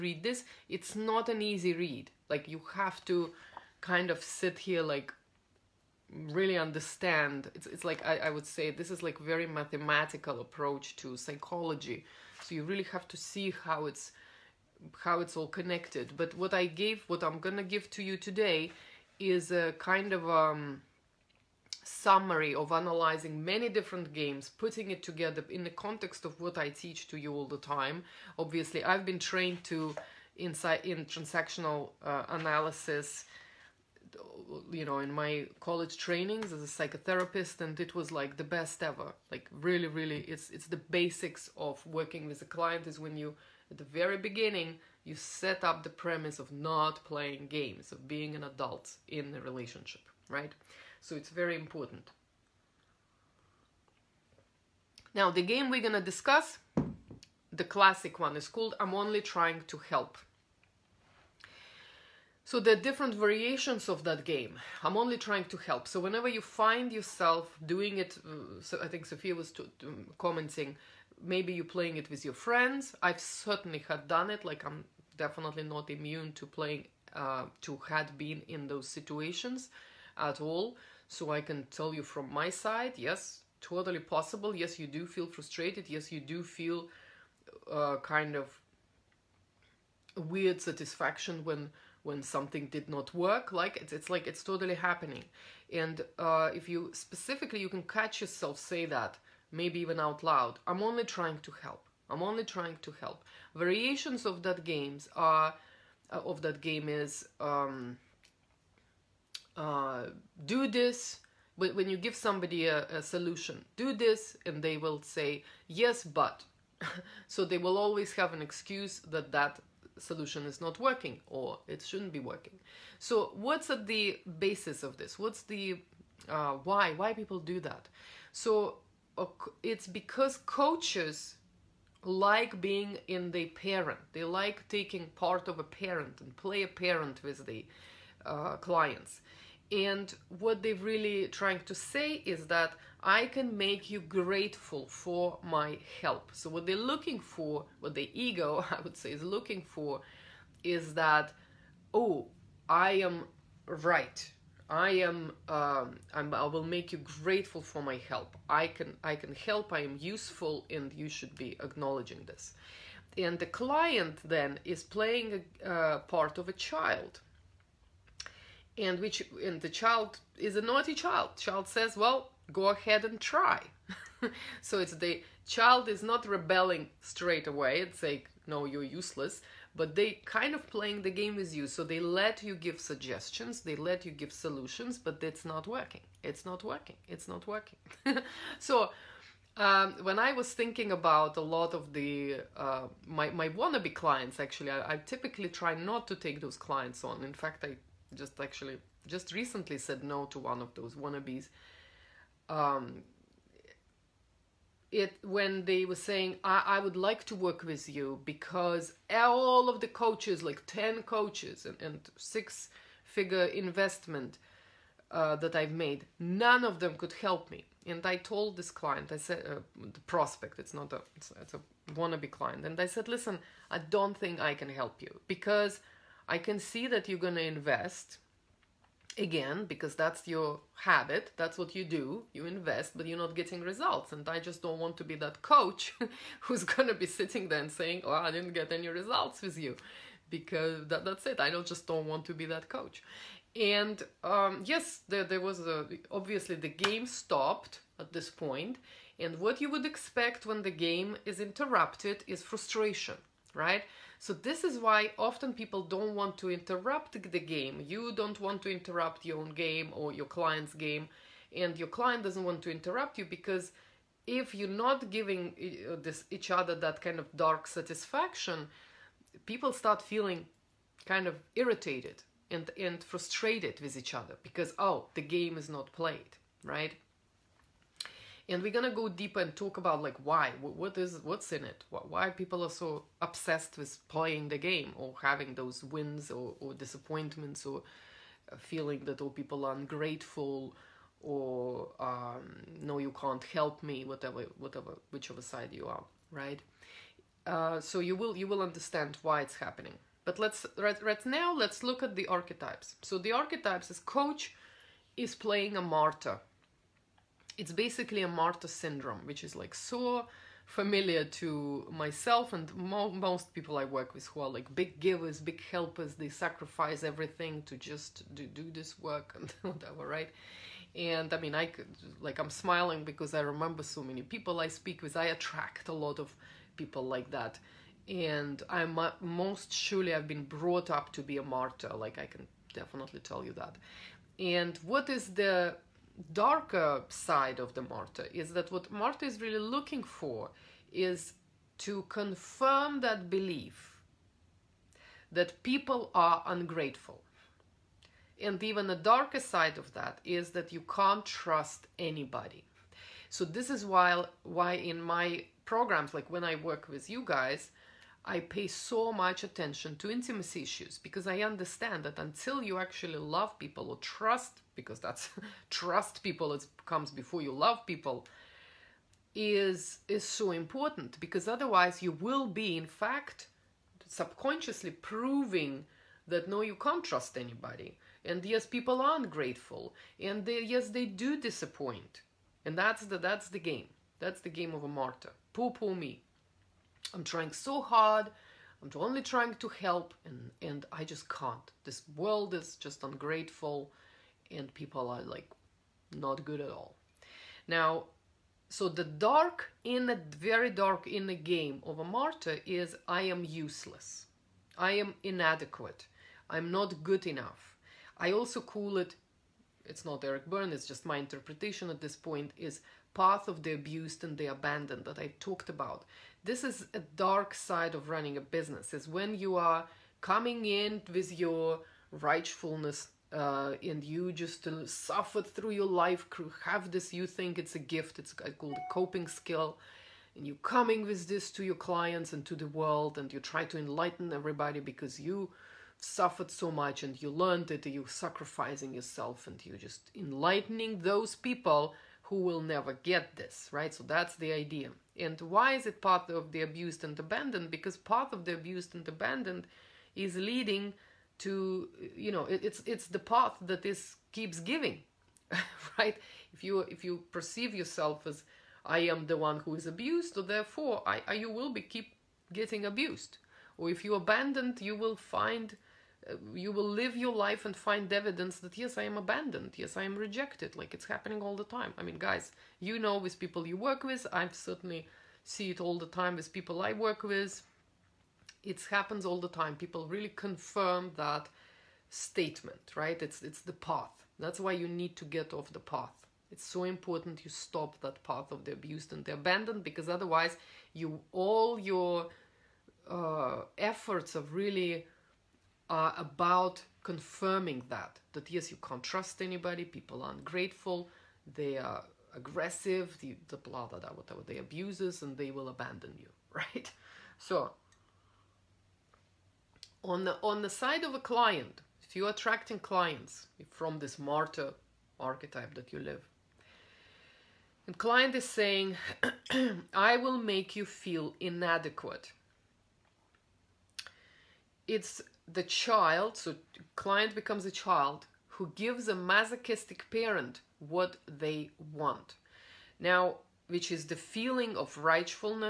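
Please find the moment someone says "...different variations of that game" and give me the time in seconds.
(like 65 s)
62 s.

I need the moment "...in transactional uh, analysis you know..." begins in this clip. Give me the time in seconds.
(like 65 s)
30 s.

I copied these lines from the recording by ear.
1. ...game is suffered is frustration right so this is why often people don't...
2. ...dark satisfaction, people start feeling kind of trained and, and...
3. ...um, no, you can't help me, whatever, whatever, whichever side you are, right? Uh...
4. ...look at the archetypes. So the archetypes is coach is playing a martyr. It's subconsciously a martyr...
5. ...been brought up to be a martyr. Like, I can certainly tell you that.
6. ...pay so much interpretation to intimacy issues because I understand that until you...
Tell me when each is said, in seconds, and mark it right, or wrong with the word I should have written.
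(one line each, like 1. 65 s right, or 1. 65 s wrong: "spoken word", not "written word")
1. 250 s wrong: "interrupted", not "suffered"
2. 267 s wrong: "irritated", not "trained"
3. 291 s right
4. 301 s wrong: "basically", not "subconsciously"
5. 330 s wrong: "definitely", not "certainly"
6. 358 s wrong: "attention", not "interpretation".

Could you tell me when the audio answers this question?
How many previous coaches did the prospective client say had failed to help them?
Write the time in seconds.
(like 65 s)
210 s.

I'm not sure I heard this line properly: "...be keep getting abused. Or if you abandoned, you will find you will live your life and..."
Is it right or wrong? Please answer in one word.
right.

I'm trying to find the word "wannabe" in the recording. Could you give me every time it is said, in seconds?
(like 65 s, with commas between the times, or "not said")
193 s, 200 s, 221 s.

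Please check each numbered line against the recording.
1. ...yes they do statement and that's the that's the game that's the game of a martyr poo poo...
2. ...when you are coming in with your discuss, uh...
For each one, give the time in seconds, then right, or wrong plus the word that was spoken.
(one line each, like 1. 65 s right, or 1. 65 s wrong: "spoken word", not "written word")
1. 380 s wrong: "disappoint", not "statement"
2. 419 s wrong: "righteousness", not "discuss".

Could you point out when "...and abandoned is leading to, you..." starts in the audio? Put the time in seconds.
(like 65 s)
448 s.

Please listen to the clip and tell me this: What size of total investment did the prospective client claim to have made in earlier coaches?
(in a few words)
six figure.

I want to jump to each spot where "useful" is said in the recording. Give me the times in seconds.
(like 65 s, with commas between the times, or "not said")
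159 s.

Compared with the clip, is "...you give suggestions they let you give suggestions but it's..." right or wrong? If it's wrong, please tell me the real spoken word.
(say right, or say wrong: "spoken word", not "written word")
wrong: "solutions", not "suggestions".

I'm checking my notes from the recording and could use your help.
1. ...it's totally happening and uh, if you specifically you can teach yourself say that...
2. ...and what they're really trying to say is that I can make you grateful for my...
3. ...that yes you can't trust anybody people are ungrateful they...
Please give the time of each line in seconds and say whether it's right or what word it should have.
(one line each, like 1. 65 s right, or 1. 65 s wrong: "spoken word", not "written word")
1. 94 s wrong: "catch", not "teach"
2. 139 s right
3. 498 s right.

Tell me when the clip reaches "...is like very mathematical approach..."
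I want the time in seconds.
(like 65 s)
8 s.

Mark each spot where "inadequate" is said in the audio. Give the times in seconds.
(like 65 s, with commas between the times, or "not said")
405 s, 521 s.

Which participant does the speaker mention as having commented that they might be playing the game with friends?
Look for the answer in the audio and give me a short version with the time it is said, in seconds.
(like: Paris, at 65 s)
Sophia, at 69 s.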